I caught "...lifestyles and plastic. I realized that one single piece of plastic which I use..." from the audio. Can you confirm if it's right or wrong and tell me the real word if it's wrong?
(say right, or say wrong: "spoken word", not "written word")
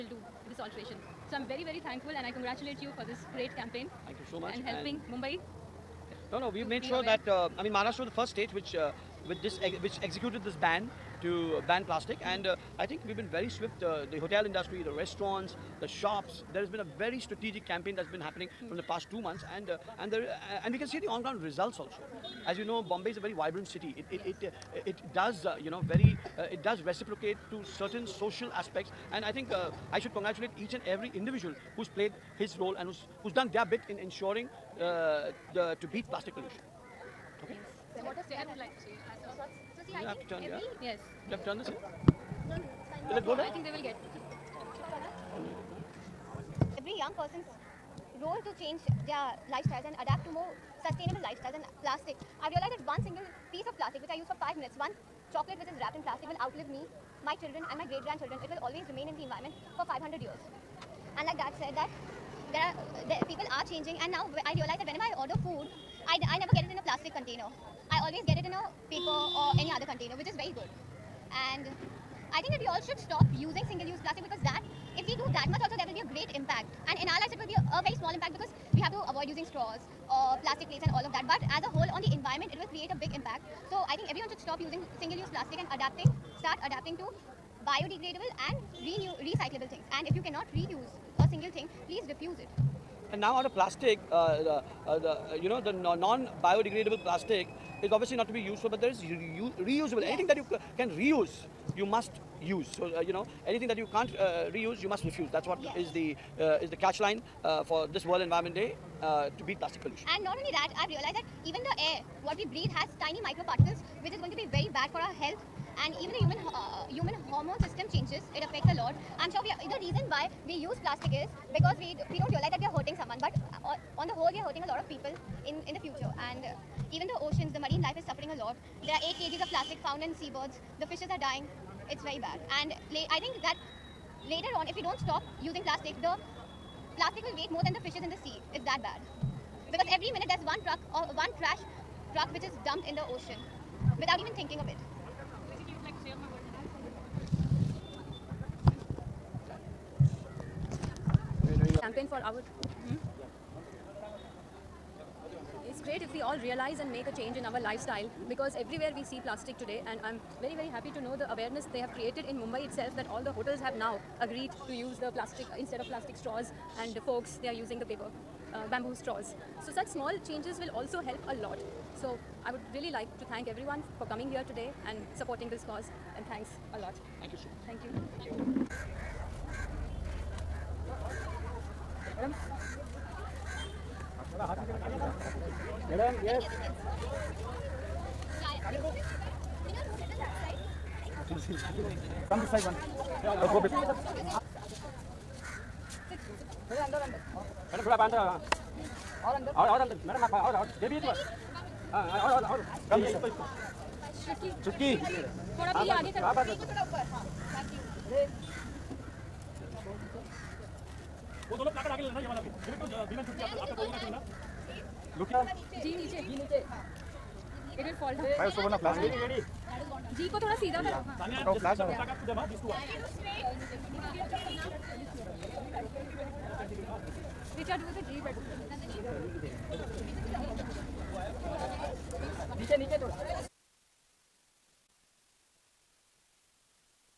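right.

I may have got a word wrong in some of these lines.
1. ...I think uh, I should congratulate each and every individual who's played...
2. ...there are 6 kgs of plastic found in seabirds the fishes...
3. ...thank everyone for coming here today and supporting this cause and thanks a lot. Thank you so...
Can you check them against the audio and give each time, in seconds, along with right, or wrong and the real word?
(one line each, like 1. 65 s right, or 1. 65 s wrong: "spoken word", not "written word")
1. 29 s right
2. 128 s wrong: "8", not "6"
3. 173 s right.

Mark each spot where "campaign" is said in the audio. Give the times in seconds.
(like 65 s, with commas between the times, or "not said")
3 s, 17 s, 151 s.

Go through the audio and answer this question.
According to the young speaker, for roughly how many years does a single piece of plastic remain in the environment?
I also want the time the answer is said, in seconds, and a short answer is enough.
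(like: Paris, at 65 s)
500 years, at 59 s.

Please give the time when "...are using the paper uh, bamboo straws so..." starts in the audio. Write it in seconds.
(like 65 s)
167 s.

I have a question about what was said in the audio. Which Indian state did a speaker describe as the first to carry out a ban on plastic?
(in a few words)
Maharashtra.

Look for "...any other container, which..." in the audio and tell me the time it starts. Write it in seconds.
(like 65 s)
69 s.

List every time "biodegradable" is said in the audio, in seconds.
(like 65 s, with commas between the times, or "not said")
87 s, 95 s.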